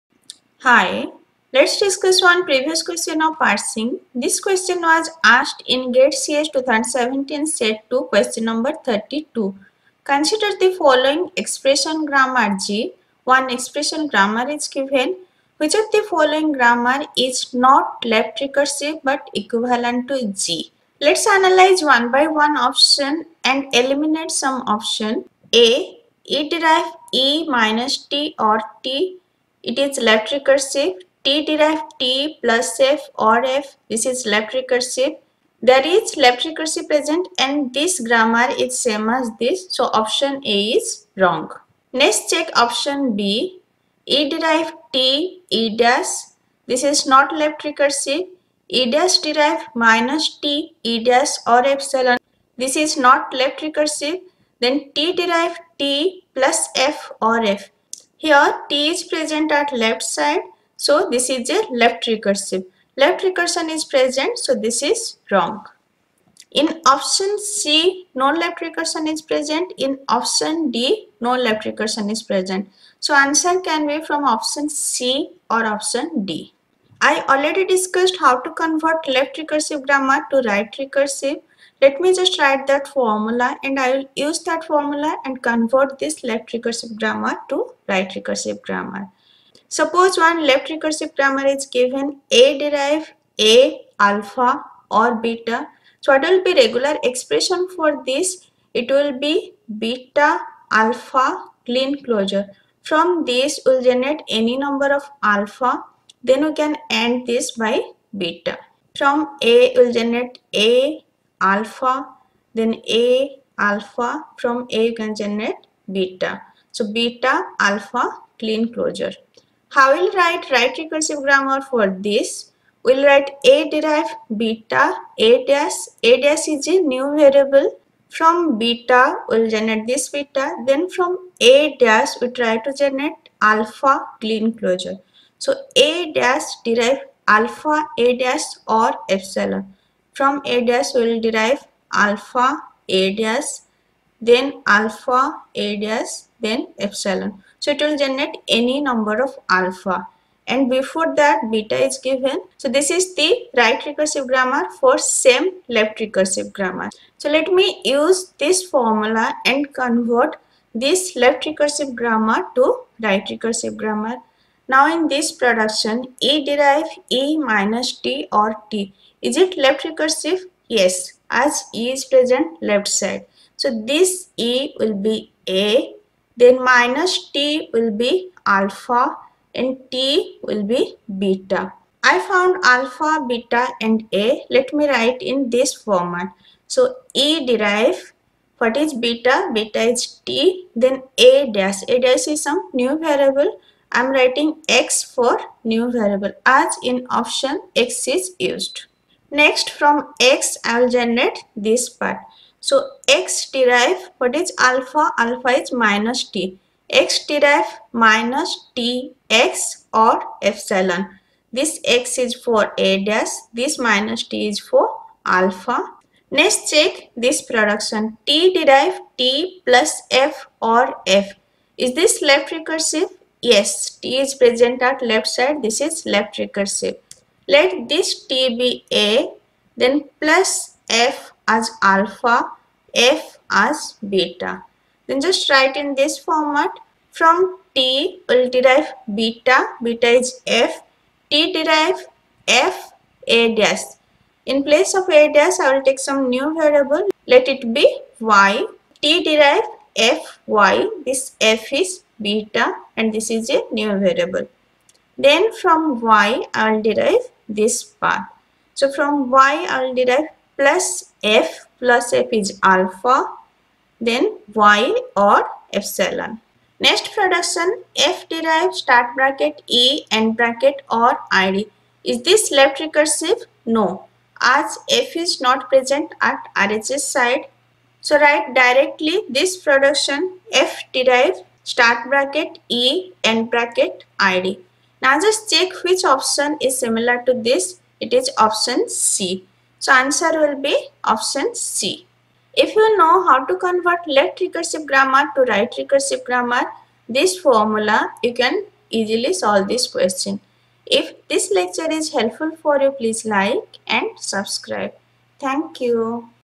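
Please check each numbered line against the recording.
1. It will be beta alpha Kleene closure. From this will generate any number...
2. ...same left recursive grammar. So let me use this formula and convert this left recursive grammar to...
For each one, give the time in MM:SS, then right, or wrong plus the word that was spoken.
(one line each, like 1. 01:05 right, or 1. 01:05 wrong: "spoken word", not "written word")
1. 01:38 right
2. 02:34 right.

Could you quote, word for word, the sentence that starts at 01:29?
Suppose one left recursive grammar is given A derive A alpha or beta.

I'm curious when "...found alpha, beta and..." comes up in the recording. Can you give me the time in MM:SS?
03:02.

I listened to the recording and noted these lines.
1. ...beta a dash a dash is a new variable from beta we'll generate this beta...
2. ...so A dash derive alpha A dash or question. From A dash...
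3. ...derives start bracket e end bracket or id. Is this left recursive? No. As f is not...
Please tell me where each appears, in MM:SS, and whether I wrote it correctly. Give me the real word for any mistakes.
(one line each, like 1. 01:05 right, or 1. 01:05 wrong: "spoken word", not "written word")
1. 02:04 right
2. 02:15 wrong: "epsilon", not "question"
3. 04:28 right.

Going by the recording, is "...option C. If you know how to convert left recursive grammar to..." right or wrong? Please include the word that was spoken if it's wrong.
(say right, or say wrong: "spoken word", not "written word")
right.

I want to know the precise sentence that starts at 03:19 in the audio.
Next from x I will generate this part.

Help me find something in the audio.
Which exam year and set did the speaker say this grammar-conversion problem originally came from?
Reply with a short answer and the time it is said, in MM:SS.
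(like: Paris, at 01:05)
GATE CS 2017 set 2, at 00:05.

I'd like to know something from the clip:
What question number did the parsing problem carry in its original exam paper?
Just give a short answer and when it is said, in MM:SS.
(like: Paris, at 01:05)
32, at 00:08.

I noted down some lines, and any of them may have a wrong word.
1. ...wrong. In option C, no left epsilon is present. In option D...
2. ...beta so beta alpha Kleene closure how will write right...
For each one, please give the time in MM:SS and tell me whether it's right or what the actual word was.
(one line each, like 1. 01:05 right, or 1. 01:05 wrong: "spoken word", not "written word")
1. 01:05 wrong: "recursion", not "epsilon"
2. 01:55 right.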